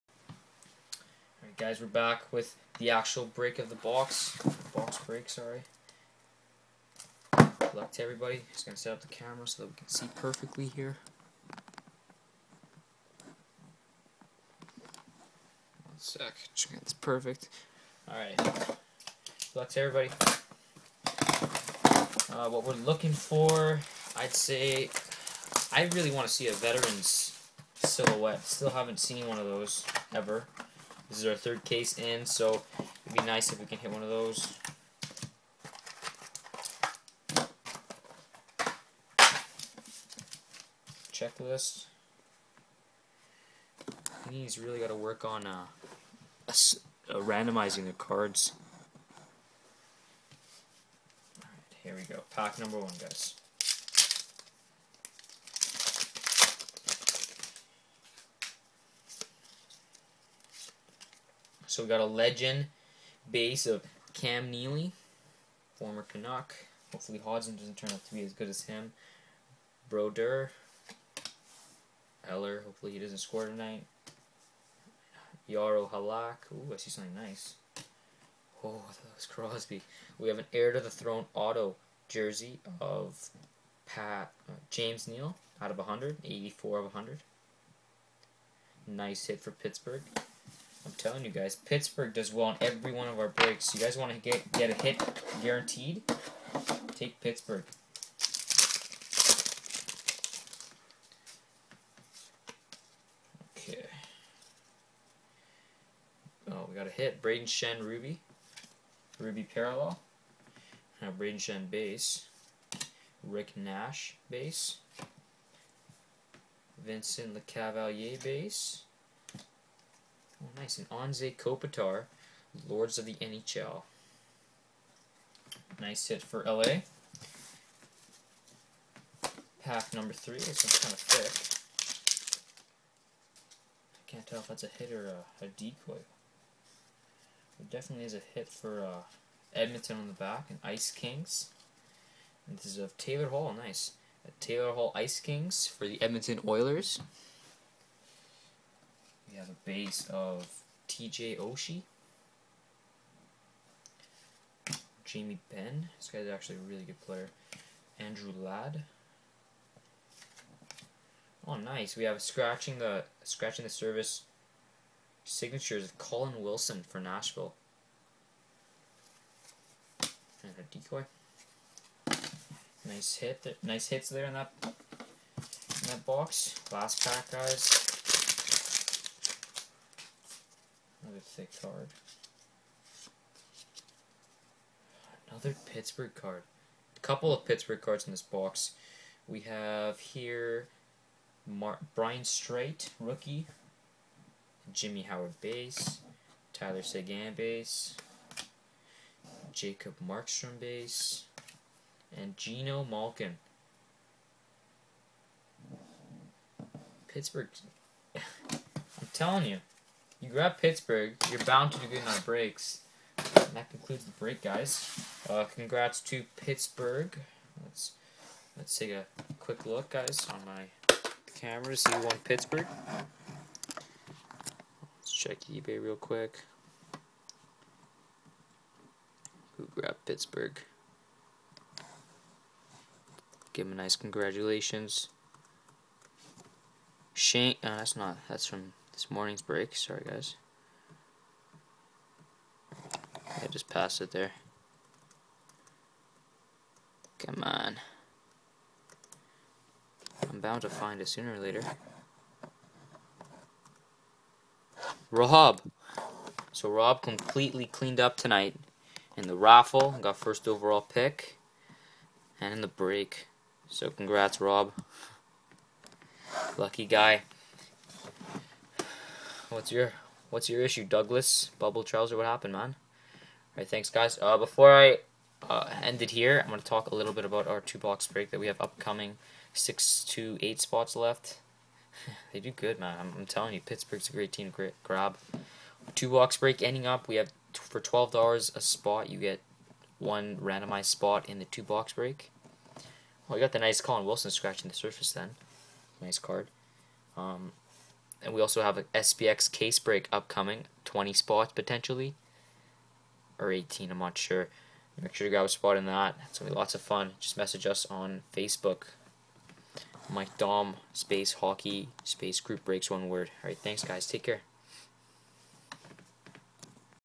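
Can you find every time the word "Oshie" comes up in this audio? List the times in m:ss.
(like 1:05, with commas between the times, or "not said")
2:31.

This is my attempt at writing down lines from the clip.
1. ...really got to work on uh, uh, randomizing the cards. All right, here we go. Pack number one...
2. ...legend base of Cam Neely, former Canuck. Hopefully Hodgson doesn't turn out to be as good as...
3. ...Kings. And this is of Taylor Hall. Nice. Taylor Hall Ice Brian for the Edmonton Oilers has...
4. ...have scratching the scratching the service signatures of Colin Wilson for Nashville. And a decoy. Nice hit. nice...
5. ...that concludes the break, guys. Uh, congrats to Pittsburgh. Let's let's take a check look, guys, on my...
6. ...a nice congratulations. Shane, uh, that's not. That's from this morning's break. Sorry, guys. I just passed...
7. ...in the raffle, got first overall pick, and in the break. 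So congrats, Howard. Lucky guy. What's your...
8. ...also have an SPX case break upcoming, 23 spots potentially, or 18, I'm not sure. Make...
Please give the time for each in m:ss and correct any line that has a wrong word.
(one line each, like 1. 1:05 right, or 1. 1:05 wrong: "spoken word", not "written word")
1. 0:44 right
2. 1:02 right
3. 2:20 wrong: "Kings", not "Brian"
4. 2:42 right
5. 3:33 wrong: "quick", not "check"
6. 3:53 right
7. 4:19 wrong: "Rob", not "Howard"
8. 4:58 wrong: "20", not "23".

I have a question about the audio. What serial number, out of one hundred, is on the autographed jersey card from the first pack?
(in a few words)
84.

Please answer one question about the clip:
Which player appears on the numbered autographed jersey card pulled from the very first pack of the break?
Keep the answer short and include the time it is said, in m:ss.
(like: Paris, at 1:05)
James Neal, at 1:24.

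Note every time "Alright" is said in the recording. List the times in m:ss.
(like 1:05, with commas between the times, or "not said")
0:18, 4:33.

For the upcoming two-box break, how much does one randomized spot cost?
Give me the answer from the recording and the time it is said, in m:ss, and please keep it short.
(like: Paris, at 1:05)
$12, at 4:47.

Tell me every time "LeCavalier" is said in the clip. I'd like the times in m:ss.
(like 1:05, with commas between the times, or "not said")
1:57.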